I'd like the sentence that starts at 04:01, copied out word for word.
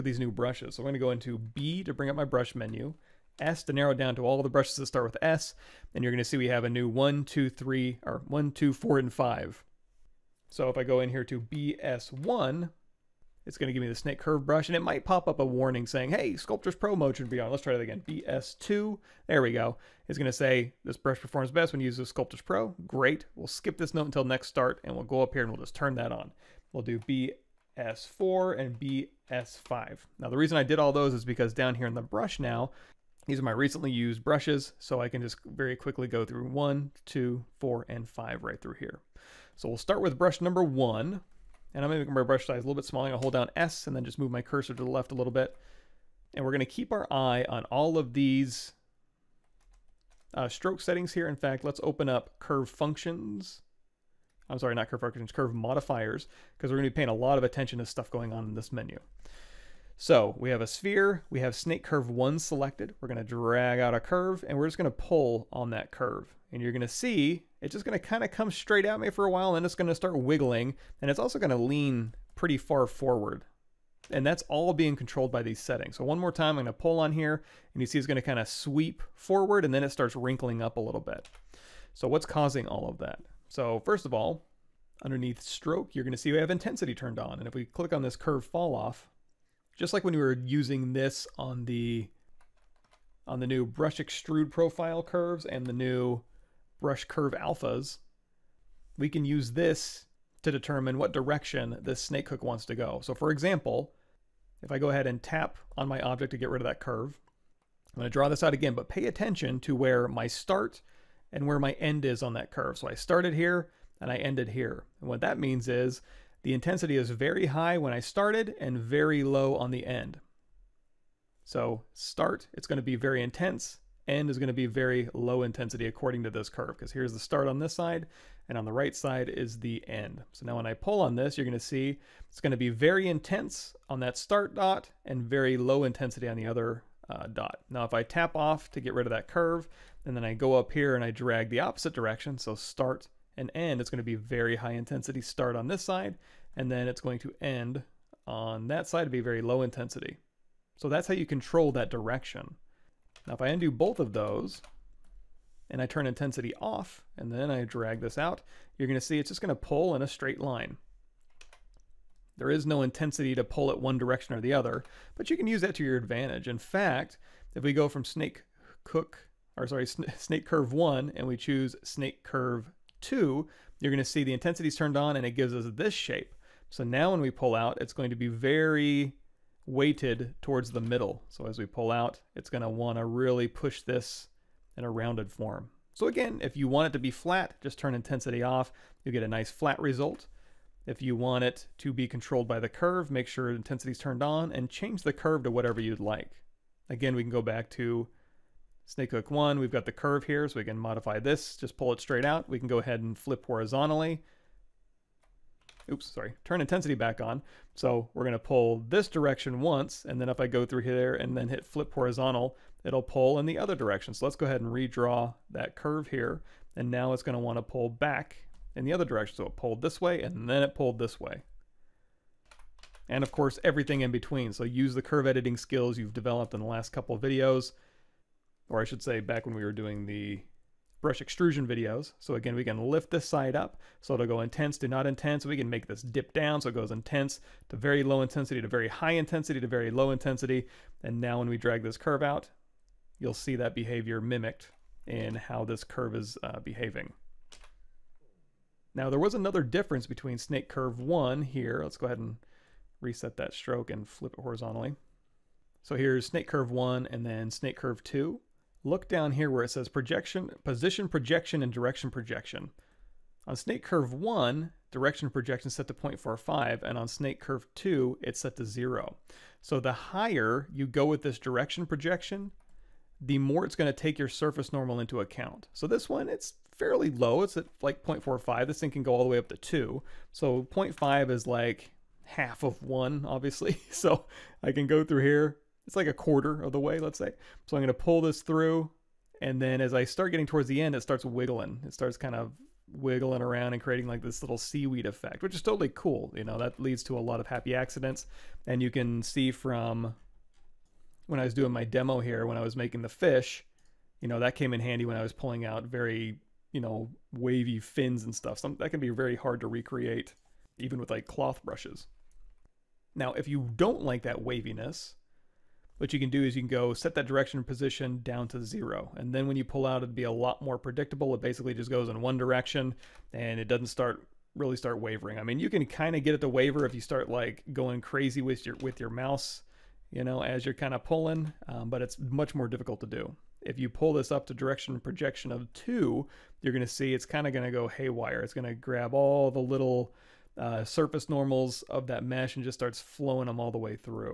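And now when we drag this curve out, you'll see that behavior mimicked in how this curve is uh, behaving.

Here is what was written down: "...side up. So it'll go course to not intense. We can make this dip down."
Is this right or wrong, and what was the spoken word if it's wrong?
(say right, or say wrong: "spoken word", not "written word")
wrong: "intense", not "course".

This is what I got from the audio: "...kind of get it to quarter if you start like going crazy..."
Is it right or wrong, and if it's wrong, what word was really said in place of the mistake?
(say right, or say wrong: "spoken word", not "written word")
wrong: "waver", not "quarter".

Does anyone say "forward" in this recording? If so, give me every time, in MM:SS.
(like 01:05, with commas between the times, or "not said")
01:12, 01:19.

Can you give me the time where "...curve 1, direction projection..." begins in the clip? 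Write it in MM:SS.
04:23.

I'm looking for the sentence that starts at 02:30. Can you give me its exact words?
So that's how you control that direction.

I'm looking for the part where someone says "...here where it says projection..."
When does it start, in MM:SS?
04:19.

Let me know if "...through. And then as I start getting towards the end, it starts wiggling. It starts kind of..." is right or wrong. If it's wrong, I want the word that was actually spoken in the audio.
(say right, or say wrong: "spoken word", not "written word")
right.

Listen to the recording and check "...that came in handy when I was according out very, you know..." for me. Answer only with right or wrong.
wrong.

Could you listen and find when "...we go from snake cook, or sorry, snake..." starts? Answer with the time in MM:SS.
02:47.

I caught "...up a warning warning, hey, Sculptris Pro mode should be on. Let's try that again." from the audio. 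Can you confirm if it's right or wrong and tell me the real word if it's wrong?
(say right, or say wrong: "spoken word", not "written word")
wrong: "saying", not "warning".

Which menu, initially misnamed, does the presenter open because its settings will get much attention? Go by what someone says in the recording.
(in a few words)
Curve modifiers.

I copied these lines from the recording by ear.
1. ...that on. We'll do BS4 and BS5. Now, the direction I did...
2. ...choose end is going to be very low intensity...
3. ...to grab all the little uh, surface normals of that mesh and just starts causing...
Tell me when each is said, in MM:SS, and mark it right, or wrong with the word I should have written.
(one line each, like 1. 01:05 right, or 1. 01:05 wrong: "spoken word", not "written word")
1. 00:25 wrong: "reason", not "direction"
2. 02:03 wrong: "intense", not "choose"
3. 05:38 wrong: "flowing", not "causing".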